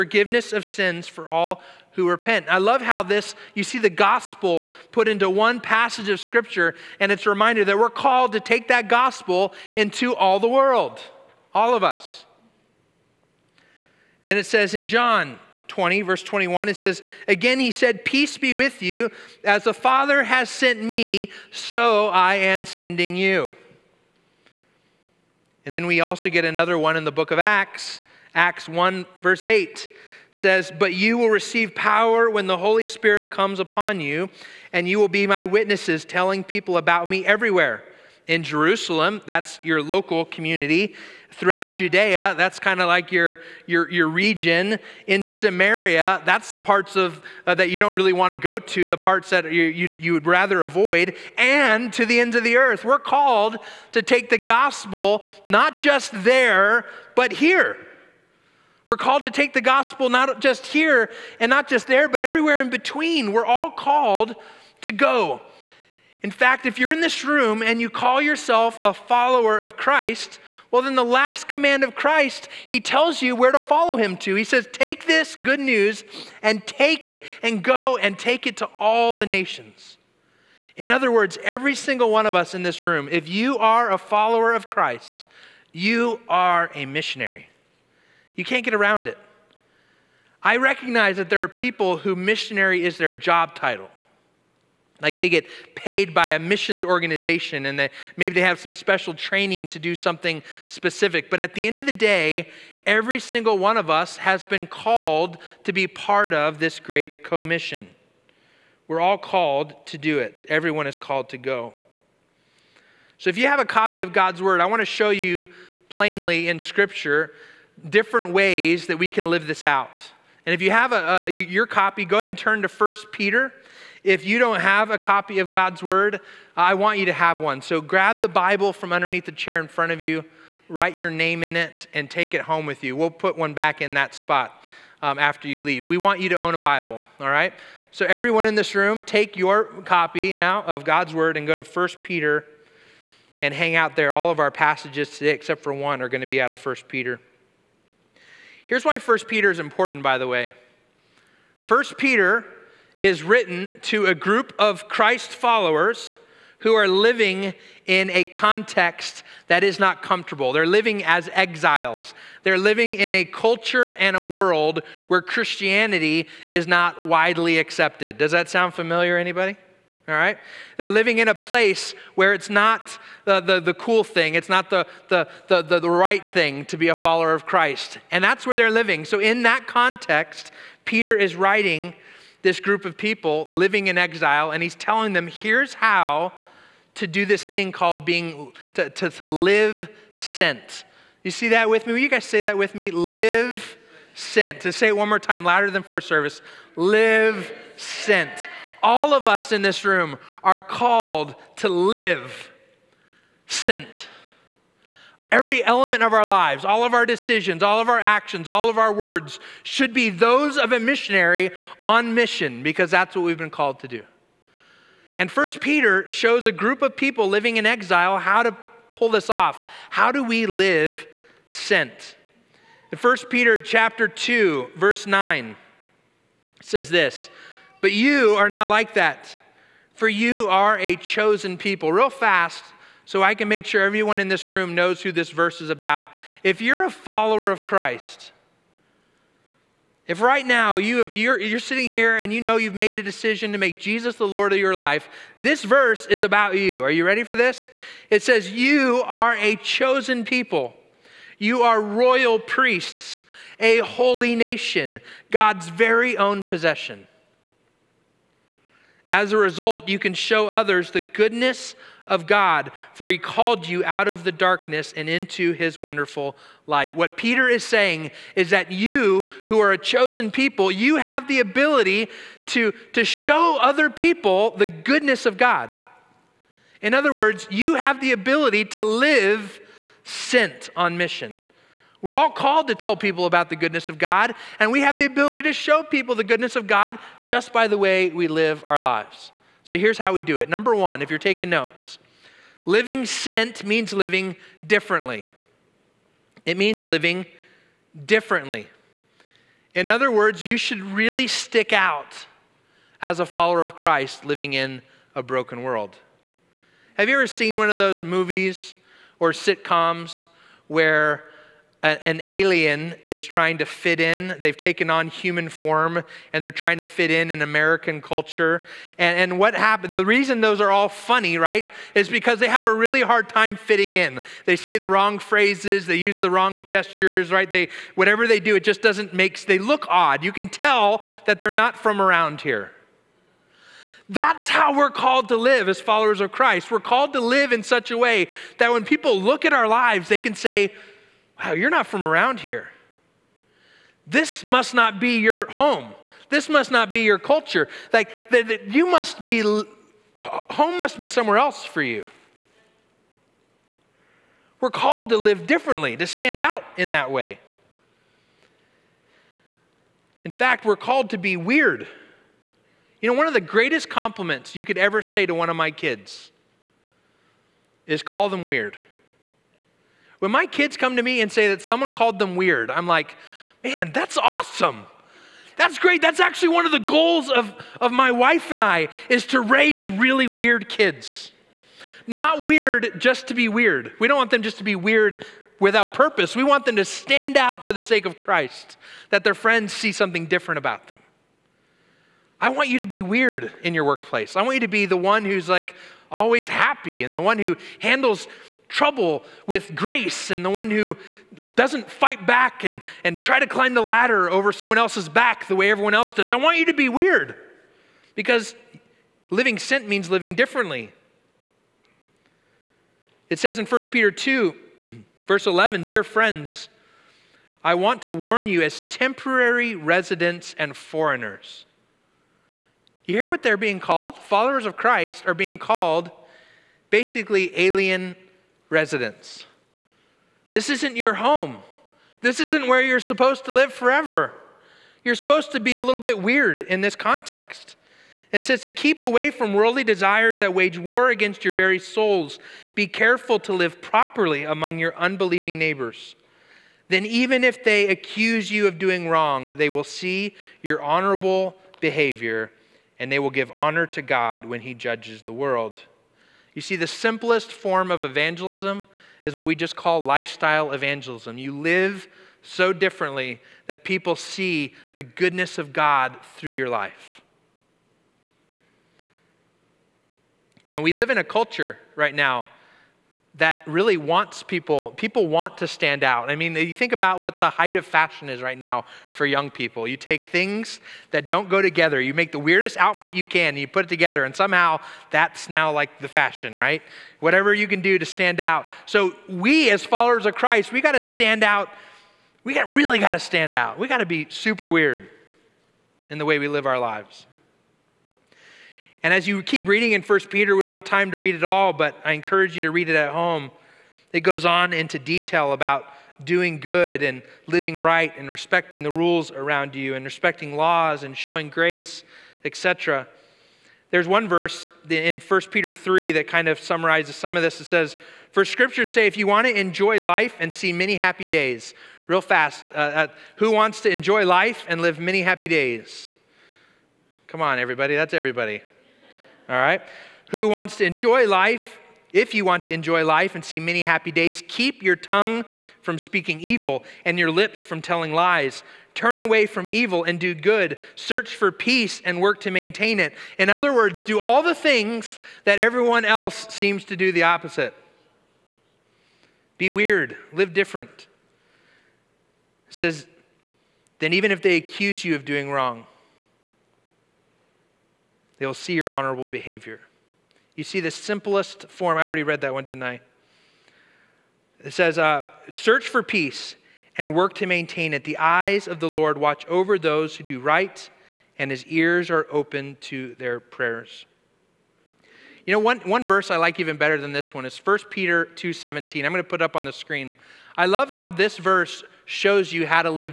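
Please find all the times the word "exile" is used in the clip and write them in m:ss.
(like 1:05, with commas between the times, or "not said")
2:41, 3:03, 3:37.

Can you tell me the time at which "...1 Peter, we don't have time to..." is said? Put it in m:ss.
8:20.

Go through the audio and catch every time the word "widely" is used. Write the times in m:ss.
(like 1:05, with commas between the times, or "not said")
2:47.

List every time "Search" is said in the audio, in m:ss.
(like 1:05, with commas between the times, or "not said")
9:00, 9:25.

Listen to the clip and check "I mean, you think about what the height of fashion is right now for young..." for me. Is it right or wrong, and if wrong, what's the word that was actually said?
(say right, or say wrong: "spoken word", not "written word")
right.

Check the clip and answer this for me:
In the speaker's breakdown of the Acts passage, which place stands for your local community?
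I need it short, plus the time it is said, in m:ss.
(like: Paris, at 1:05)
Jerusalem, at 0:38.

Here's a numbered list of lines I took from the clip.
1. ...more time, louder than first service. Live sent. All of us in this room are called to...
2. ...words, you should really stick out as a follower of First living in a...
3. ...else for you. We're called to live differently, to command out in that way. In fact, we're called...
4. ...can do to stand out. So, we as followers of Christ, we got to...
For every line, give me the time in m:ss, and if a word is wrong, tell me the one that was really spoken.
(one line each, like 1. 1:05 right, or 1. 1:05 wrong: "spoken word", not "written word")
1. 3:15 right
2. 5:00 wrong: "Christ", not "First"
3. 5:51 wrong: "stand", not "command"
4. 8:07 right.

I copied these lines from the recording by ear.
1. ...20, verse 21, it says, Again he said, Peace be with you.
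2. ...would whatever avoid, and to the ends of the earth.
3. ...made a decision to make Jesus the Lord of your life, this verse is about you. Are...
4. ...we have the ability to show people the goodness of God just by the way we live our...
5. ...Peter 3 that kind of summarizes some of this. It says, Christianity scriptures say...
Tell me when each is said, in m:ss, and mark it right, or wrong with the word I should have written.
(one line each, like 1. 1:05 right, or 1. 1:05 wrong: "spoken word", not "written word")
1. 0:15 right
2. 0:50 wrong: "rather", not "whatever"
3. 4:02 right
4. 4:44 right
5. 8:35 wrong: "For", not "Christianity".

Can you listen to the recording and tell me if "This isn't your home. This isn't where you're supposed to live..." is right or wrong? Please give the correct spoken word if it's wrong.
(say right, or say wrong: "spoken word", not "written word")
right.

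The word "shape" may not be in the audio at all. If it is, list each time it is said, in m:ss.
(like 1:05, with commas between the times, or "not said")
not said.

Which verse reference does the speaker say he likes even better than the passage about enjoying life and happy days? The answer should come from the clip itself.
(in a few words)
1 Peter 2:17.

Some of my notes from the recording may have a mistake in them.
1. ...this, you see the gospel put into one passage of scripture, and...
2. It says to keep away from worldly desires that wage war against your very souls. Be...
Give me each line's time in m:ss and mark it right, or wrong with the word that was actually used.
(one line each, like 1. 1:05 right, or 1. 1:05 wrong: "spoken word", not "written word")
1. 0:03 right
2. 7:18 right.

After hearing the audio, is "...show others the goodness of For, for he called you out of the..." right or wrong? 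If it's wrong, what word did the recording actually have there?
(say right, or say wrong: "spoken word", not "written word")
wrong: "God", not "For".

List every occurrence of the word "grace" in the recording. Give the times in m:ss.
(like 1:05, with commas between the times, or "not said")
6:39, 8:31.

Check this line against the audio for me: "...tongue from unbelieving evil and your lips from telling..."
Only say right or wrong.
wrong.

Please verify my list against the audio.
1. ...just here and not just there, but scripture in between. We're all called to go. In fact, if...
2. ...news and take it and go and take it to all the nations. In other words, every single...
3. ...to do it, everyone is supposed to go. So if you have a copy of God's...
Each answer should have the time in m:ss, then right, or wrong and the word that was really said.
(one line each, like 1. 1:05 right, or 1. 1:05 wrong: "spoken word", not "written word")
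1. 1:00 wrong: "everywhere", not "scripture"
2. 1:15 right
3. 1:49 wrong: "called", not "supposed".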